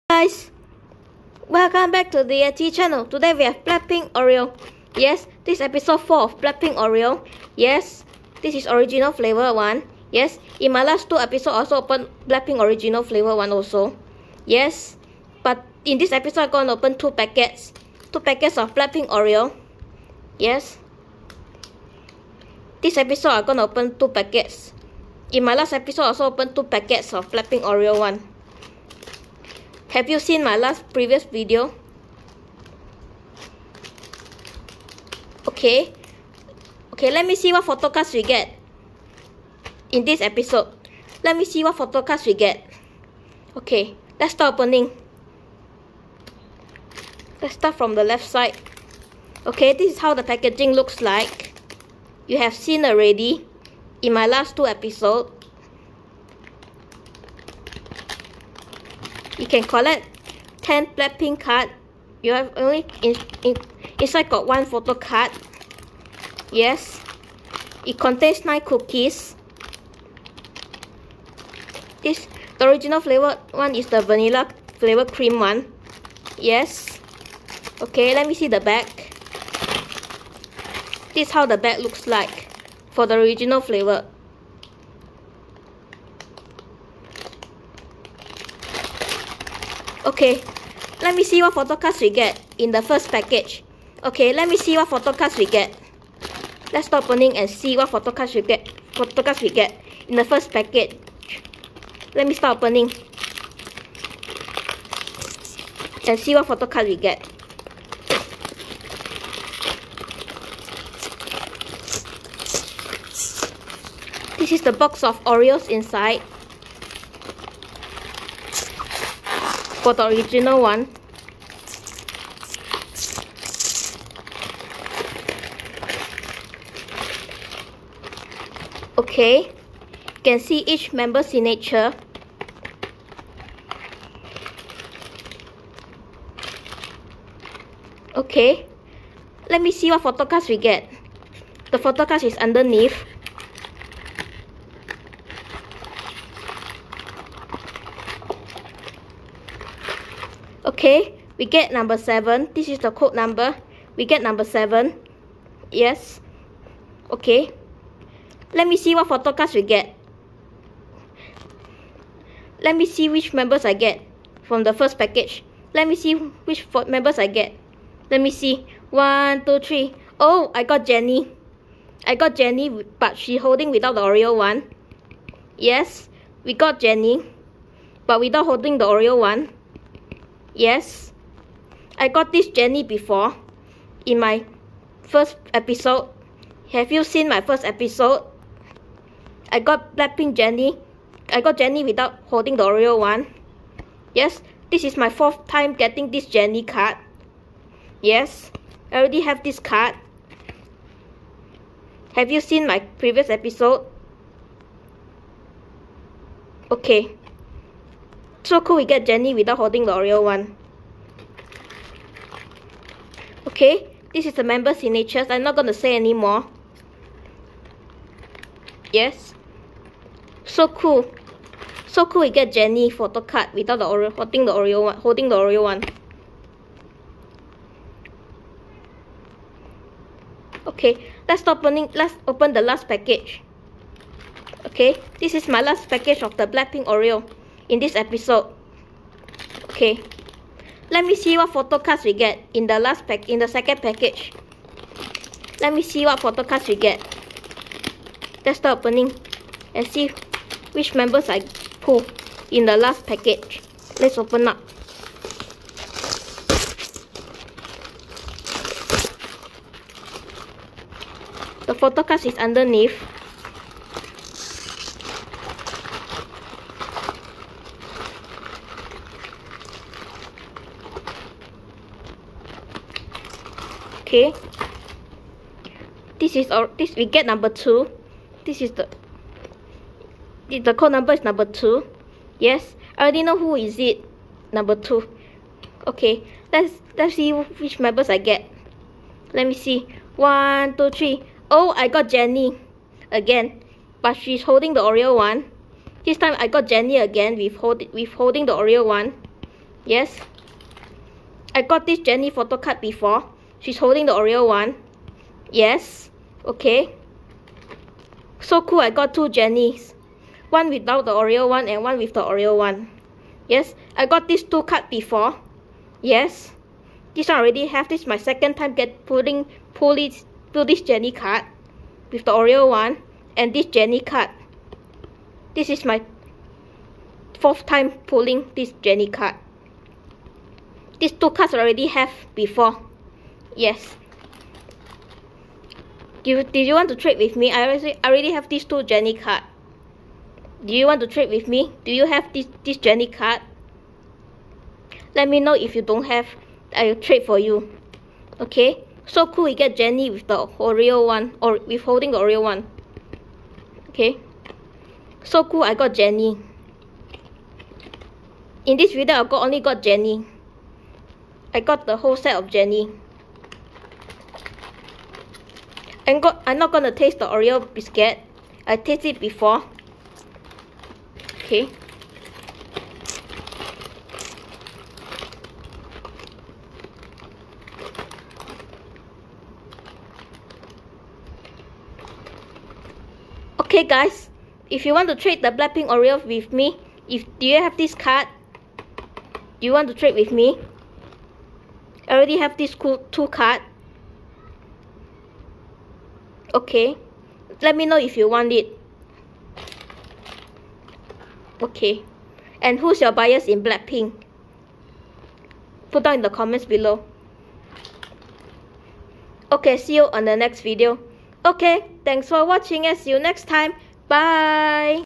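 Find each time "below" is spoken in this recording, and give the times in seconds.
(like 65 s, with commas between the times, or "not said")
406 s.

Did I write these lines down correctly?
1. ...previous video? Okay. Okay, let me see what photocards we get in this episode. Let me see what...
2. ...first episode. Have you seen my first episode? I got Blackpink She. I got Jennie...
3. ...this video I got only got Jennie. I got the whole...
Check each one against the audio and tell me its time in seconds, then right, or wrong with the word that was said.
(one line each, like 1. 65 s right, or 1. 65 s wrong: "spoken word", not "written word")
1. 30 s right
2. 185 s wrong: "Jennie", not "She"
3. 358 s right.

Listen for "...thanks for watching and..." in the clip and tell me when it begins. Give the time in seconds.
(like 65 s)
412 s.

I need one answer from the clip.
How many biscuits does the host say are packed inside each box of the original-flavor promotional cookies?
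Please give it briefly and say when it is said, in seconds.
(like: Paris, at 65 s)
9, at 68 s.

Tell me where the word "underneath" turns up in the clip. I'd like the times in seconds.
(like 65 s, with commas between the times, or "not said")
142 s, 262 s.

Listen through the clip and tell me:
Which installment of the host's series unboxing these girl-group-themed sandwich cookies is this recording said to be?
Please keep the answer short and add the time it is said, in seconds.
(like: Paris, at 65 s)
Episode 4, at 5 s.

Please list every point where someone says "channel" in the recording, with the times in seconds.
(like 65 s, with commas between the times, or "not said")
2 s.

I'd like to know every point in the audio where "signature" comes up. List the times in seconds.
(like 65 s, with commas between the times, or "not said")
131 s, 214 s.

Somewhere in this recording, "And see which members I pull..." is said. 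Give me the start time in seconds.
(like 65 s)
249 s.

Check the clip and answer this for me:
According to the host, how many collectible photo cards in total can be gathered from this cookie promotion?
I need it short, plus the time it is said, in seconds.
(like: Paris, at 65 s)
10, at 60 s.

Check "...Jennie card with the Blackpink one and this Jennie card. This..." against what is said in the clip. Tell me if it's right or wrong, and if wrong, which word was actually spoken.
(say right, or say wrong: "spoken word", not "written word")
wrong: "Oreo", not "Blackpink".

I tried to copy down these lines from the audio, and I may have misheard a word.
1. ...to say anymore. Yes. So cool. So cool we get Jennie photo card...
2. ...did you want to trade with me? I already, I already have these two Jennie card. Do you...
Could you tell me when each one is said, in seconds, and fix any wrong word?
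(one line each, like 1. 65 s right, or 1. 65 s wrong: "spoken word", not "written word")
1. 215 s right
2. 336 s right.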